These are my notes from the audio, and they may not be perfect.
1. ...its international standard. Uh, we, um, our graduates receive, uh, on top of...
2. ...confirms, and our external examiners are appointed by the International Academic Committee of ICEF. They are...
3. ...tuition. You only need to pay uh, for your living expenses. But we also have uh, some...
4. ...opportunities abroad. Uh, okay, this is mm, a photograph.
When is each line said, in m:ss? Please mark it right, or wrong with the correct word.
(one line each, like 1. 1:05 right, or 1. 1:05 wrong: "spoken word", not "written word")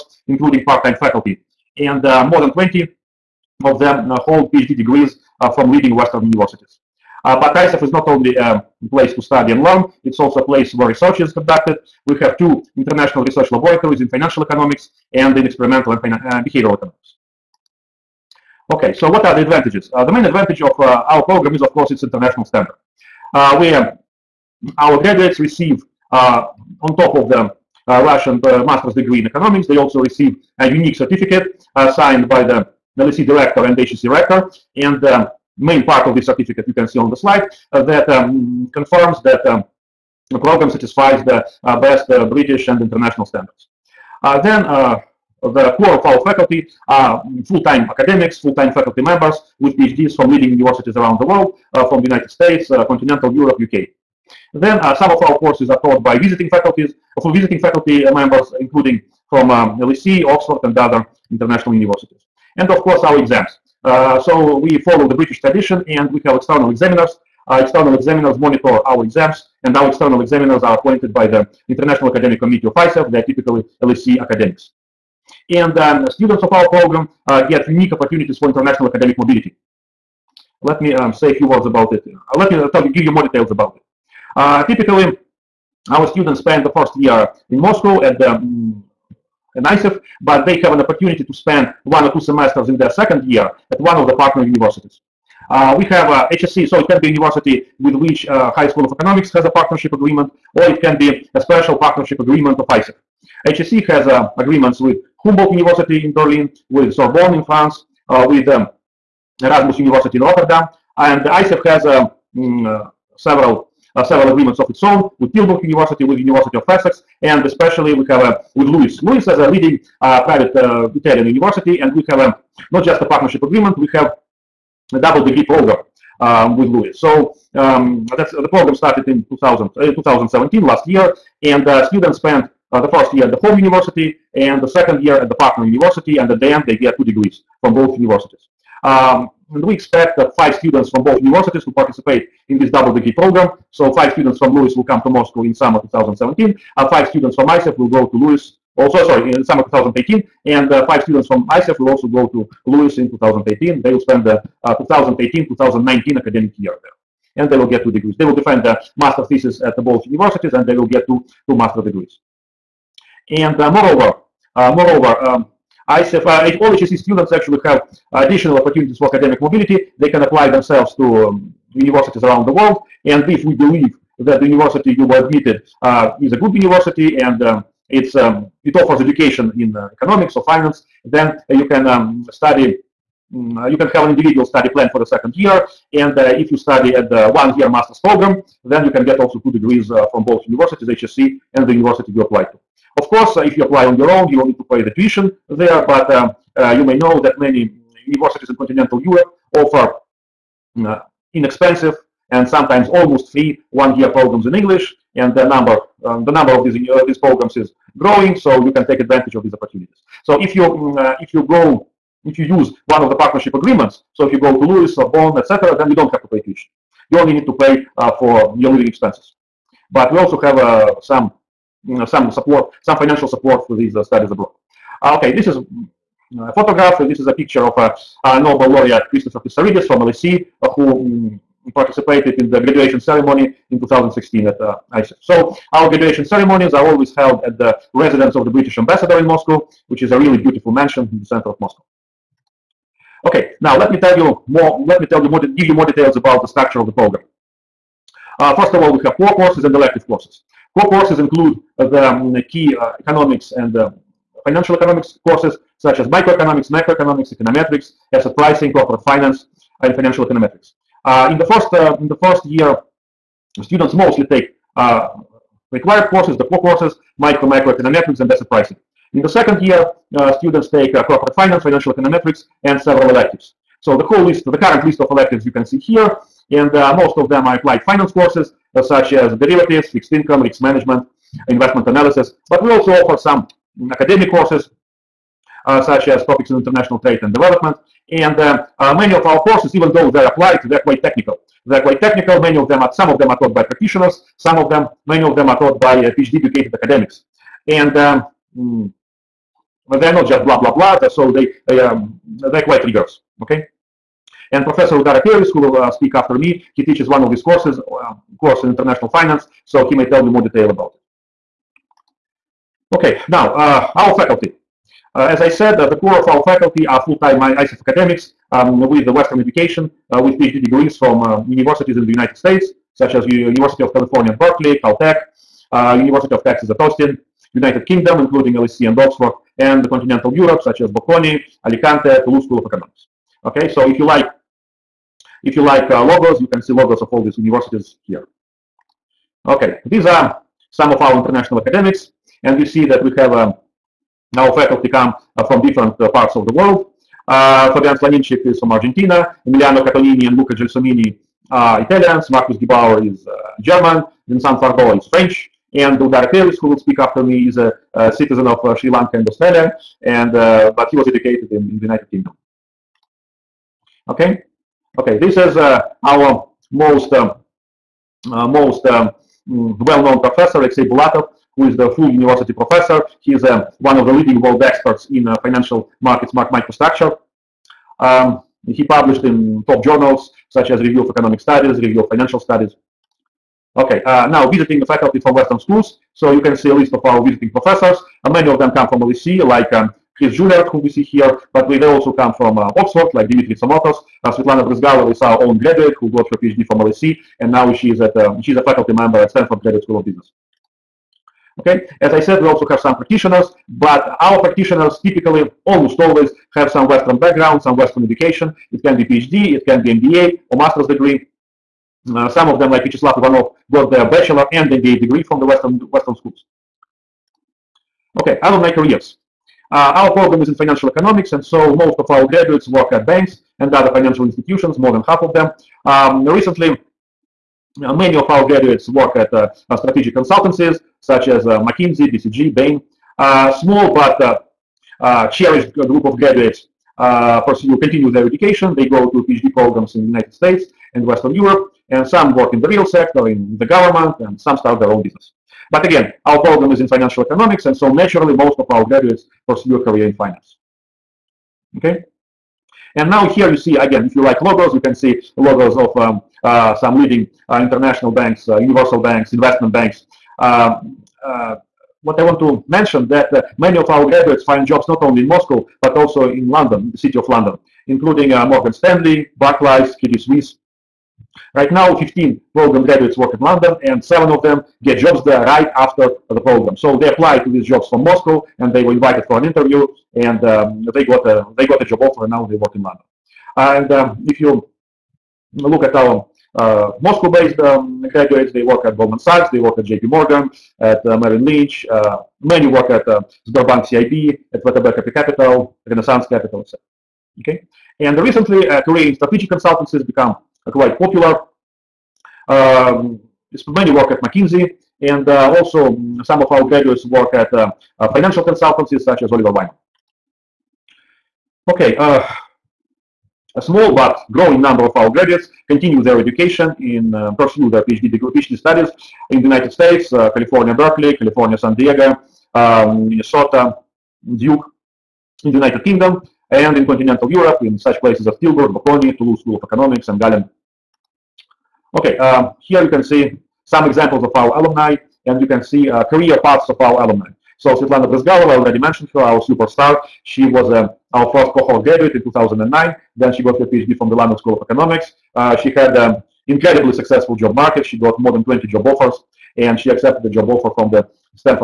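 1. 0:21 right
2. 1:09 wrong: "exams", not "confirms"
3. 3:36 right
4. 3:44 wrong: "studies", not "opportunities".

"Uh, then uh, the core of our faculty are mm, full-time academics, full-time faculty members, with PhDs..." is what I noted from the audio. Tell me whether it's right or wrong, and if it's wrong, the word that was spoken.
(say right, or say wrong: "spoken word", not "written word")
right.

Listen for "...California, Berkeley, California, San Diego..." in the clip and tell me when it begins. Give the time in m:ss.
8:40.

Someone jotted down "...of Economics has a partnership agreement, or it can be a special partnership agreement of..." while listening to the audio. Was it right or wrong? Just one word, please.
right.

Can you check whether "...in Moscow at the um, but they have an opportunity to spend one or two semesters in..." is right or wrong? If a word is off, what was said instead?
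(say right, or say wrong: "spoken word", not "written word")
right.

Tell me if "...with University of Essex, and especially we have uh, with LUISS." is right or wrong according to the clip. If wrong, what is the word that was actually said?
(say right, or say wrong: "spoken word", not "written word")
right.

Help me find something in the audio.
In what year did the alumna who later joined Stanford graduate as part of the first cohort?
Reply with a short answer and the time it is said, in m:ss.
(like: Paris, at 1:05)
2009, at 9:02.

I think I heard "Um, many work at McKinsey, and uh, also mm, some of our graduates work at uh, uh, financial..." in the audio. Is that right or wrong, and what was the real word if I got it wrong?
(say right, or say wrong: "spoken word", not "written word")
right.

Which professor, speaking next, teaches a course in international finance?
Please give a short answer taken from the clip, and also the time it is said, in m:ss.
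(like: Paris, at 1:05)
Udara Peiris, at 5:04.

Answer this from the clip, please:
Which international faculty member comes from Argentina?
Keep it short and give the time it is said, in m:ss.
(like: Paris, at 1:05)
Fabian Slonimczyk, at 5:47.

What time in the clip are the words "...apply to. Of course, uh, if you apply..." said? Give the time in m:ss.
3:12.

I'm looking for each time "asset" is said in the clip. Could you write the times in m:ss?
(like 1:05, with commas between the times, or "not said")
4:18, 4:28.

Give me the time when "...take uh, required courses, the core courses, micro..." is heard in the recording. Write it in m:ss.
4:24.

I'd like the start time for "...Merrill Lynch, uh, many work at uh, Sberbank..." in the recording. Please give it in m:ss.
8:11.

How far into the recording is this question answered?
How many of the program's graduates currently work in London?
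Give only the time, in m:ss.
7:51.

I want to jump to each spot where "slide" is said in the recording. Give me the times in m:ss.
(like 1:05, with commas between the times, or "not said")
0:37.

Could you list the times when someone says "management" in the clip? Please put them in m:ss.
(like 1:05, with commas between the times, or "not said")
4:40.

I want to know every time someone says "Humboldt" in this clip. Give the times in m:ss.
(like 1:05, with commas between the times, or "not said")
1:45.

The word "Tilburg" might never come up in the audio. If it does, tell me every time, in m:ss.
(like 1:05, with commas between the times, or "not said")
1:55, 8:48.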